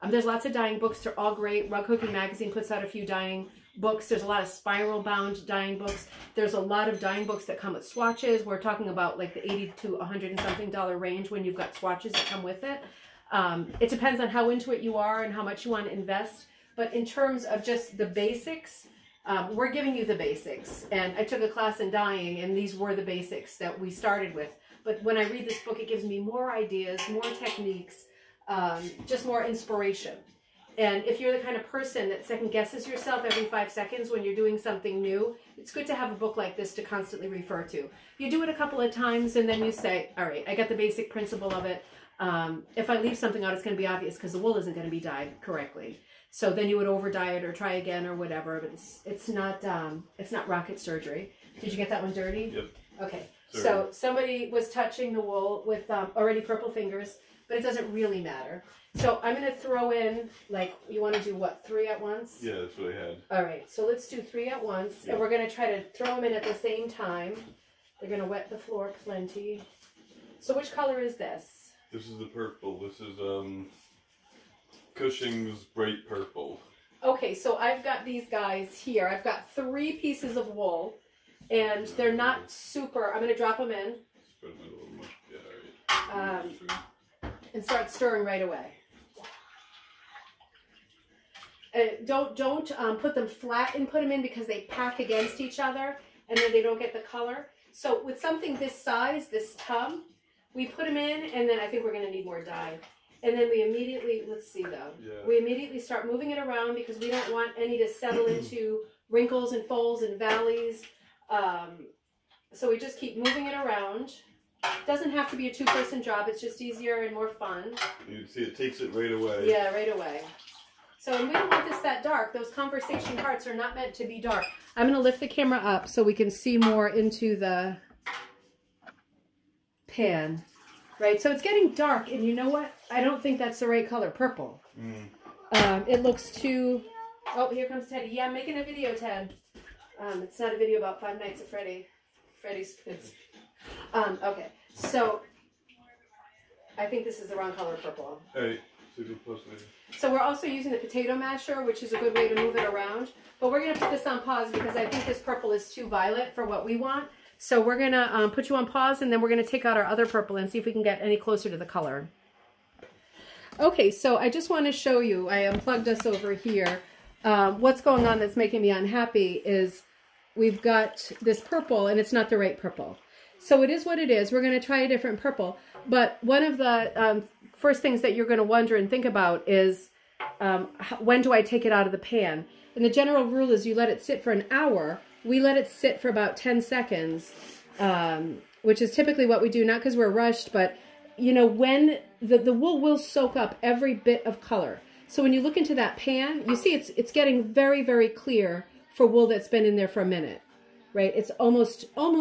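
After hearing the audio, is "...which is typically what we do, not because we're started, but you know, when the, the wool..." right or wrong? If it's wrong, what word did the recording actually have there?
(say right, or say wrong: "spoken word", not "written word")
wrong: "rushed", not "started".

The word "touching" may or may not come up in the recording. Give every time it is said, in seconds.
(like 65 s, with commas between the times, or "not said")
54 s.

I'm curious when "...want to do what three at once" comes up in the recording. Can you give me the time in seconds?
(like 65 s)
61 s.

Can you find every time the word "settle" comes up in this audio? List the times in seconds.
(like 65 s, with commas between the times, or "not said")
107 s.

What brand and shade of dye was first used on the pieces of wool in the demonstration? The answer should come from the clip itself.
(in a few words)
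Cushing's bright purple.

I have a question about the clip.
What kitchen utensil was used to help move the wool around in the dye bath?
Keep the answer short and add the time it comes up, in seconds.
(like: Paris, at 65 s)
Potato masher, at 150 s.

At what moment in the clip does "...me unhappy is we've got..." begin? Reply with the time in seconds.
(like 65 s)
168 s.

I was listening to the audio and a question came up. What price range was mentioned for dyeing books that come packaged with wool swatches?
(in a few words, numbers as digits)
80 to 100 and something dollars.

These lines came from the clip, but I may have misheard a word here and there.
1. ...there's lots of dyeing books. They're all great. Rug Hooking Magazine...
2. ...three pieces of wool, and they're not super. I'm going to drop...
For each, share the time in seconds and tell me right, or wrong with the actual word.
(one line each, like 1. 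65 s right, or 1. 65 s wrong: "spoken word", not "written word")
1. 0 s right
2. 79 s right.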